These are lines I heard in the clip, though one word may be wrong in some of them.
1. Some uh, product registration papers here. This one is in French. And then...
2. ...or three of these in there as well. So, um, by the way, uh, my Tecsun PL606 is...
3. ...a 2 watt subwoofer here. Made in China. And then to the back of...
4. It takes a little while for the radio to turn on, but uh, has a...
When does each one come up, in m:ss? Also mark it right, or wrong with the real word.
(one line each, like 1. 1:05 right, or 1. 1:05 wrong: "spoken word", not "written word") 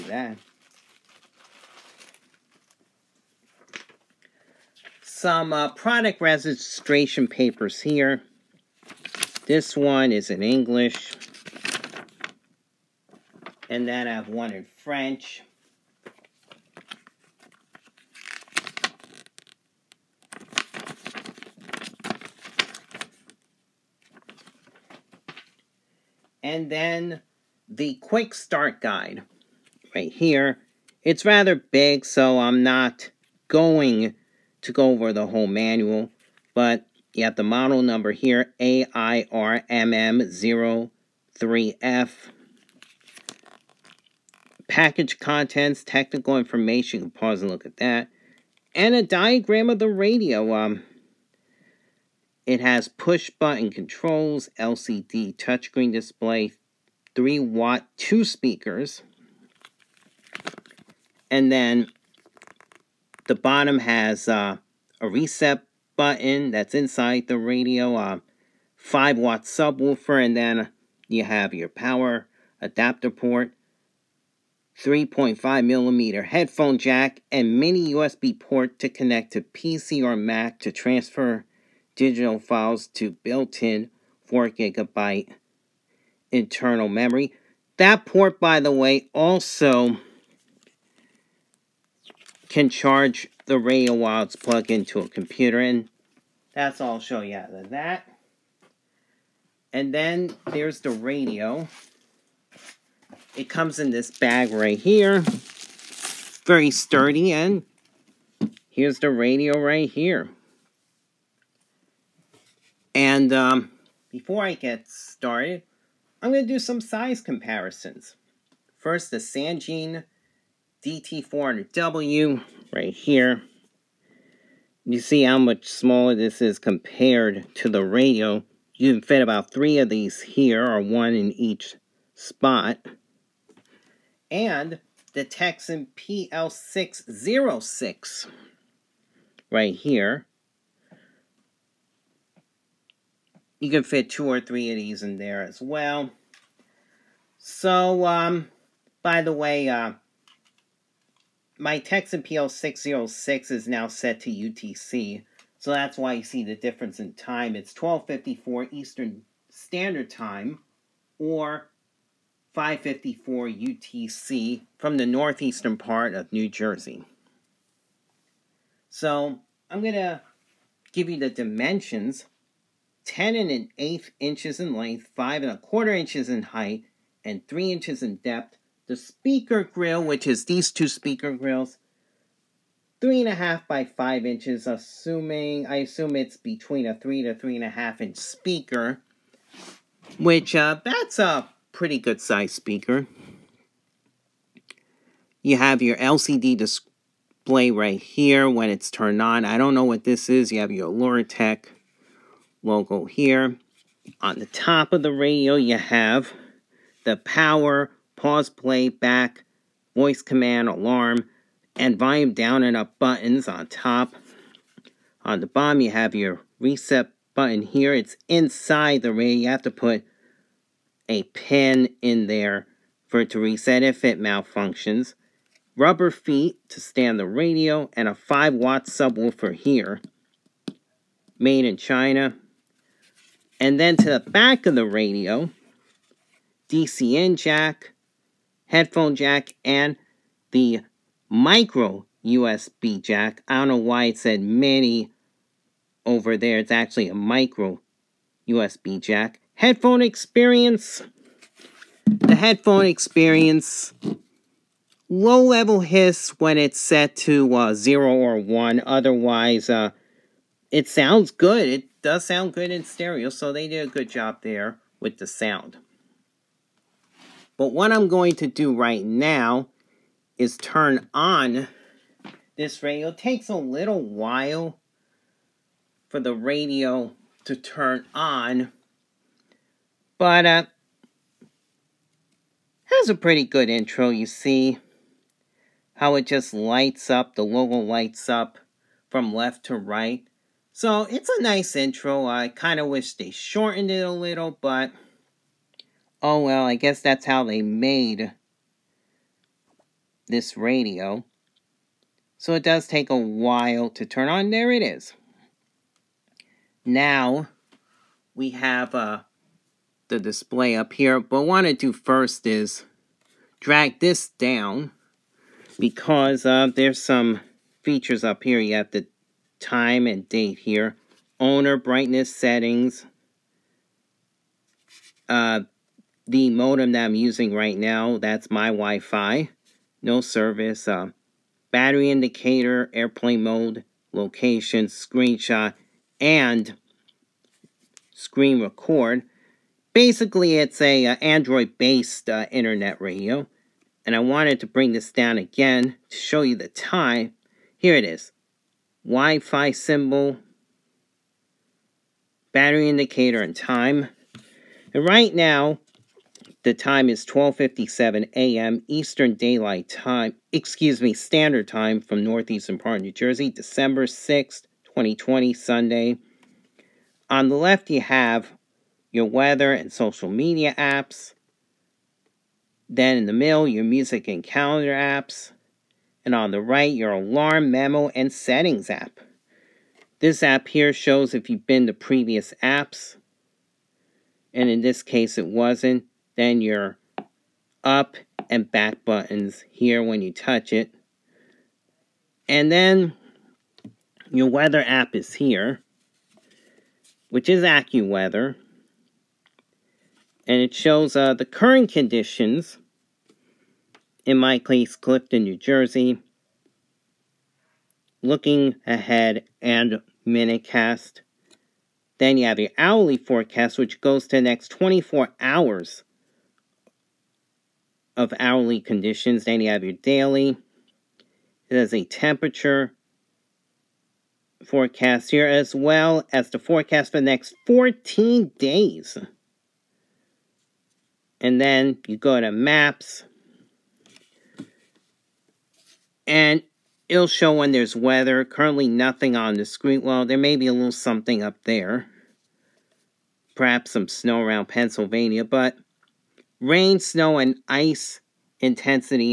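1. 0:05 wrong: "English", not "French"
2. 2:24 right
3. 3:48 wrong: "5", not "2"
4. 4:33 right.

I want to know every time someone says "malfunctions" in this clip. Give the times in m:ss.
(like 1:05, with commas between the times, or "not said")
3:44.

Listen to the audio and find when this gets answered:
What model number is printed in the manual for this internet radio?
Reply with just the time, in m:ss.
0:38.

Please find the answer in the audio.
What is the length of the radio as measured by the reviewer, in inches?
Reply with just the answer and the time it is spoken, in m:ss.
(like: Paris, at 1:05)
10 1/8 inches, at 2:53.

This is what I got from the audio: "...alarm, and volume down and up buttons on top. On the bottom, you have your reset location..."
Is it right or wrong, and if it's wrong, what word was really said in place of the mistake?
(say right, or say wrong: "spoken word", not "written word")
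wrong: "button", not "location".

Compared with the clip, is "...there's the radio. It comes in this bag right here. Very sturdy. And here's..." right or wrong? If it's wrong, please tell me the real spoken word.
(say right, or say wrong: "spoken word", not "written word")
right.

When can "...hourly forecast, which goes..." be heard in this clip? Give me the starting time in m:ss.
6:52.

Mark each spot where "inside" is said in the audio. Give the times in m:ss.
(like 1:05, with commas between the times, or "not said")
1:06, 3:38.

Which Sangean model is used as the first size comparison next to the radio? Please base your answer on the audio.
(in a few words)
DT400W.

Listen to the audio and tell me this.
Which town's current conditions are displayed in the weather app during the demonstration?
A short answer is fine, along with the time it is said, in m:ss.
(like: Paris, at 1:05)
Clifton, New Jersey, at 6:44.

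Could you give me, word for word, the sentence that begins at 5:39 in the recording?
Basically, it's a uh, Android-based uh, internet radio, and I wanted to bring this down again to show you the time.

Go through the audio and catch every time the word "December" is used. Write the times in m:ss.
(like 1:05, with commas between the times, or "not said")
6:03.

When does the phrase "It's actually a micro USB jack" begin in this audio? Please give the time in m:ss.
4:06.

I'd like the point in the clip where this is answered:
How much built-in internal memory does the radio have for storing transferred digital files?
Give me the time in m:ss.
1:24.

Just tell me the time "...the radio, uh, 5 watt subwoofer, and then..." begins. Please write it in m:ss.
1:07.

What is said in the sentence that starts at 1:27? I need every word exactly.
That port, by the way, also can charge the radio while it's plugged into a computer.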